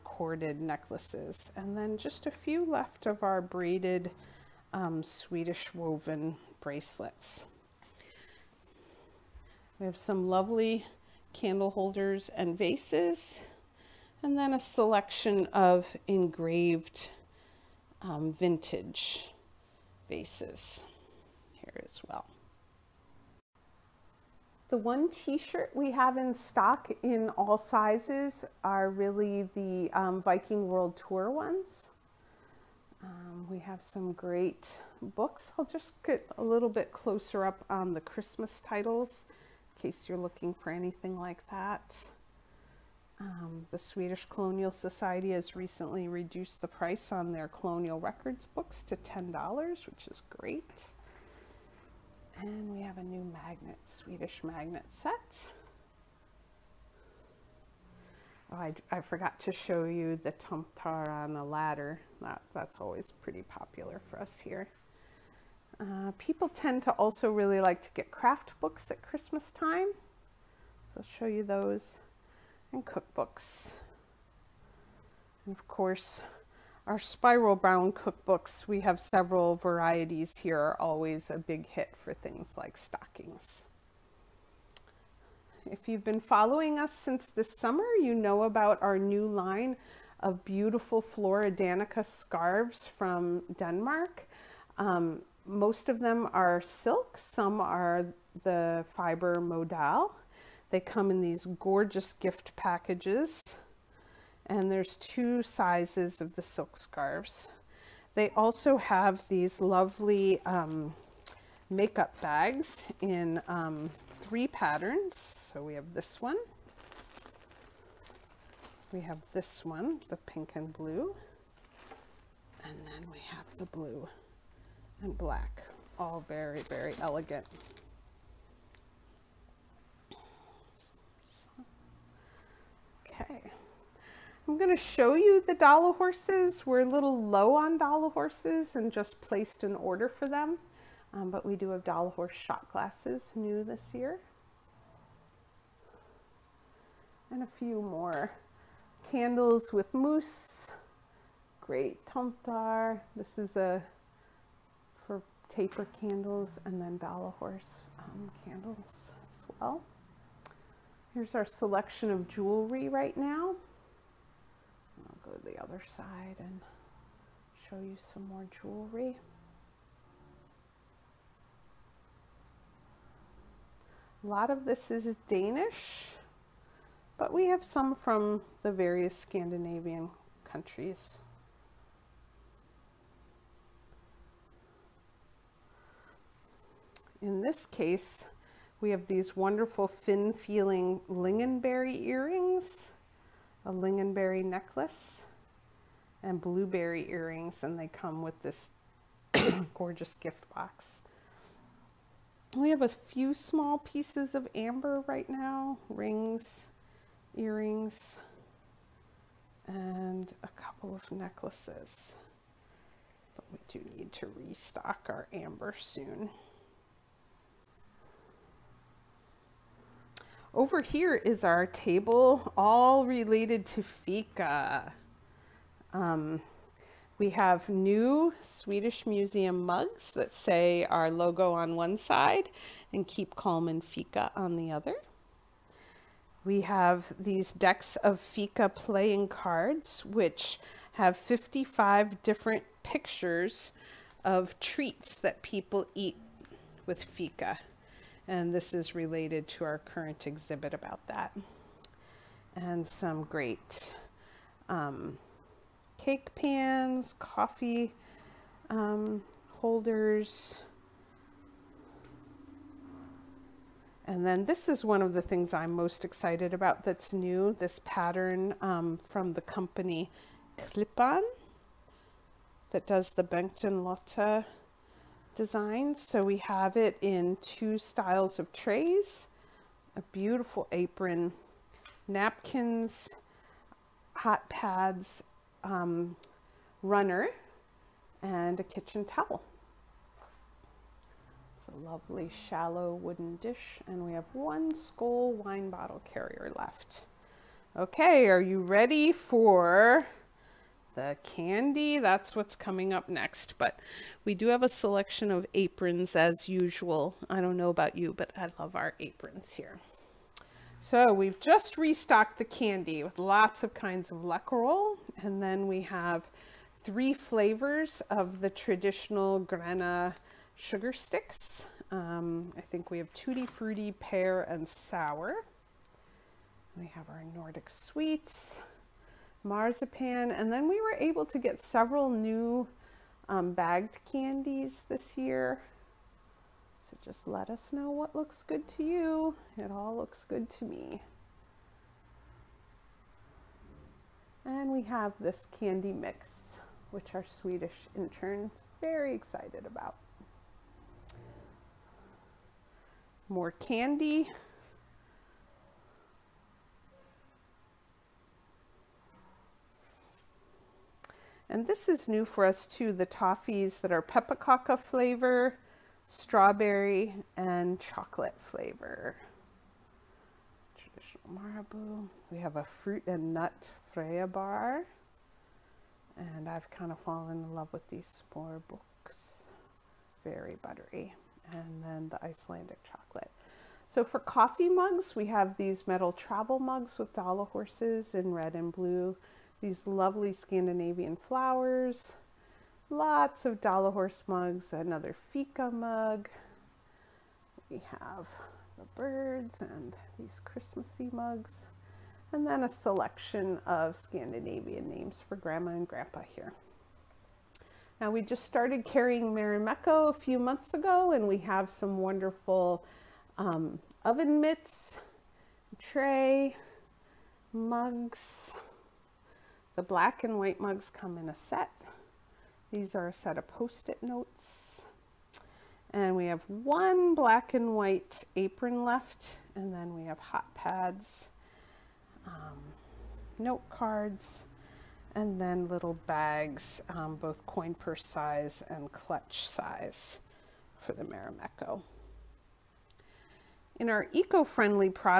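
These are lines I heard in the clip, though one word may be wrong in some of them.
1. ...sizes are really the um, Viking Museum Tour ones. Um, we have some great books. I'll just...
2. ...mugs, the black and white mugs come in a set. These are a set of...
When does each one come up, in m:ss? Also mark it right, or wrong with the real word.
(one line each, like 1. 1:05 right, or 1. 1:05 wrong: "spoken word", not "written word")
1. 0:27 wrong: "World", not "Museum"
2. 6:57 right.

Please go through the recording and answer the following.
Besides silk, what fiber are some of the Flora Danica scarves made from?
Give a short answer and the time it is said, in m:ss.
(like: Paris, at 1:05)
modal, at 1:39.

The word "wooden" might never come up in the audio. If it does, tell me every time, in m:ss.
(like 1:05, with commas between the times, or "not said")
4:52.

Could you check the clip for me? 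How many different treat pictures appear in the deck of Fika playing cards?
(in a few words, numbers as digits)
55.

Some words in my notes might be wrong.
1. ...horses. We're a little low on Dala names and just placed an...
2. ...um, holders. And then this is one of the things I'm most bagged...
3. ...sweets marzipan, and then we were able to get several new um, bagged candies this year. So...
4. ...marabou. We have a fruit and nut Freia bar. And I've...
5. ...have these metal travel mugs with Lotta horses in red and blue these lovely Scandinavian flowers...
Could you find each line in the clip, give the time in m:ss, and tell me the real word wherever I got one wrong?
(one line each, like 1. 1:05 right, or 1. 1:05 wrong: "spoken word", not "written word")
1. 2:15 wrong: "horses", not "names"
2. 4:18 wrong: "excited", not "bagged"
3. 5:27 right
4. 6:11 right
5. 6:25 wrong: "Dala", not "Lotta".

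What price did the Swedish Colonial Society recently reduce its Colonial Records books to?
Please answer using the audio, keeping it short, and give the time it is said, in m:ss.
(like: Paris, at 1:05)
$10, at 0:48.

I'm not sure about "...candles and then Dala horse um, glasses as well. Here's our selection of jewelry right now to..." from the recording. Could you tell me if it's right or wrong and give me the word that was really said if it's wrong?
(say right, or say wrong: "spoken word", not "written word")
wrong: "candles", not "glasses".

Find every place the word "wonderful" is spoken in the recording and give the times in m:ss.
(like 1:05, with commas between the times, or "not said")
3:09, 6:51.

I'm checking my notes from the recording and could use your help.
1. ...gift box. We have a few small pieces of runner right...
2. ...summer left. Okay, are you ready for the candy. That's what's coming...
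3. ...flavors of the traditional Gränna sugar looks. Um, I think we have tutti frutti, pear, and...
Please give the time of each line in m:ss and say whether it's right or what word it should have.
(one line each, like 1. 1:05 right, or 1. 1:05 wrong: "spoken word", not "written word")
1. 3:20 wrong: "amber", not "runner"
2. 4:56 wrong: "carrier", not "summer"
3. 5:17 wrong: "sticks", not "looks".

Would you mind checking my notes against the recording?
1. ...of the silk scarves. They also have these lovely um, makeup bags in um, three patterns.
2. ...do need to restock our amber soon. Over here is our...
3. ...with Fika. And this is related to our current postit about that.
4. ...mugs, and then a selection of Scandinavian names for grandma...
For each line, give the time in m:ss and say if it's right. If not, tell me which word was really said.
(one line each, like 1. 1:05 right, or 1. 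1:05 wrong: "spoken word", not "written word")
1. 1:46 right
2. 3:33 right
3. 4:06 wrong: "exhibit", not "postit"
4. 6:41 right.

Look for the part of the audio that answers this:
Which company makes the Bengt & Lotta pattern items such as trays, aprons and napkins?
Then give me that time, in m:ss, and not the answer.
4:30.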